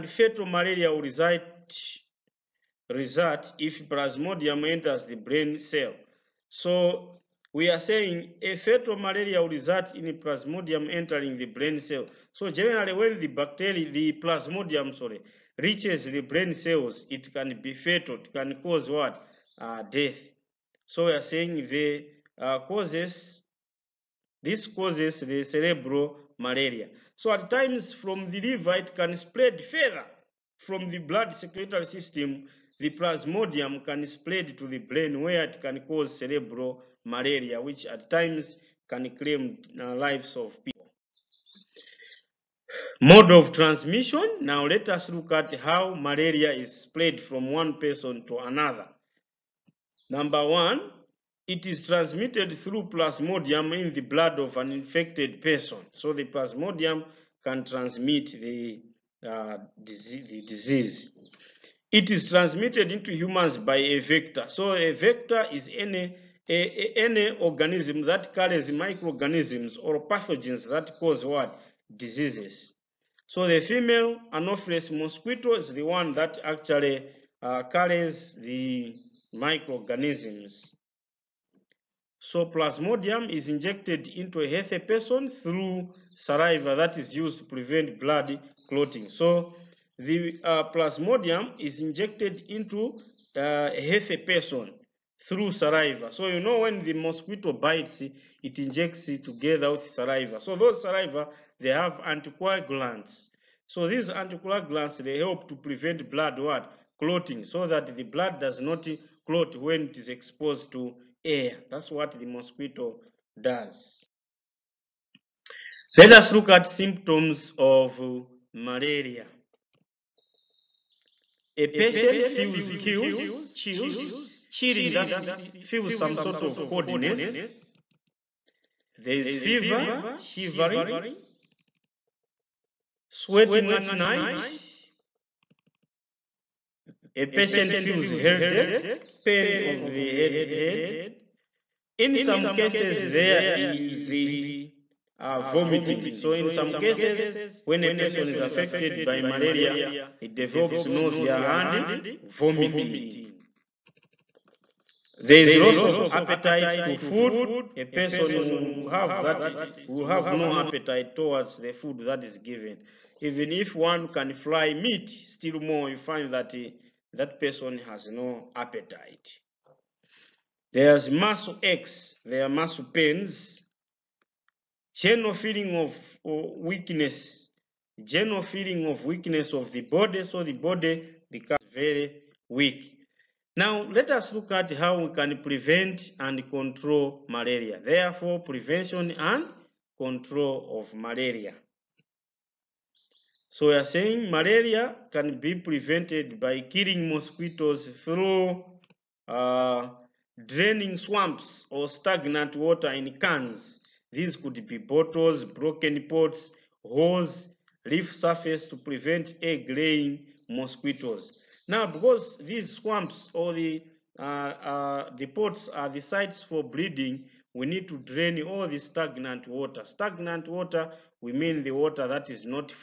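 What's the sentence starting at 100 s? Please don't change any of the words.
So those saliva, they have anticoagulants.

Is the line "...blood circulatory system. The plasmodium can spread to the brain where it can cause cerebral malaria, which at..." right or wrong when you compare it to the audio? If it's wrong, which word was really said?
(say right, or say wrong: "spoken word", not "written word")
right.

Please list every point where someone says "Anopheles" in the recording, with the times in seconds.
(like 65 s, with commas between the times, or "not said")
74 s.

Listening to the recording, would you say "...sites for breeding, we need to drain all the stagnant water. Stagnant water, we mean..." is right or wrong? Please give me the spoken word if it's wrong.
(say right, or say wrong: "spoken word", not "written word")
right.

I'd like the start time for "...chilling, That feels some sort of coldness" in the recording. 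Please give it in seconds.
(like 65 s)
124 s.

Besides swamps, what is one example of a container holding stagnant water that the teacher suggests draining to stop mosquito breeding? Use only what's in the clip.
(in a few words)
Broken pots.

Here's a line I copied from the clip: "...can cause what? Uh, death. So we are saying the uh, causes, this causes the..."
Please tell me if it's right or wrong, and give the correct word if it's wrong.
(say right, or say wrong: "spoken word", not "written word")
right.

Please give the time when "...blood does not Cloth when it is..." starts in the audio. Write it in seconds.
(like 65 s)
108 s.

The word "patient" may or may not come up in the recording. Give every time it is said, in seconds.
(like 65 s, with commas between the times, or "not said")
121 s, 137 s.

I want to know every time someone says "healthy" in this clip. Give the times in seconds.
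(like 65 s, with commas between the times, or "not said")
84 s, 93 s.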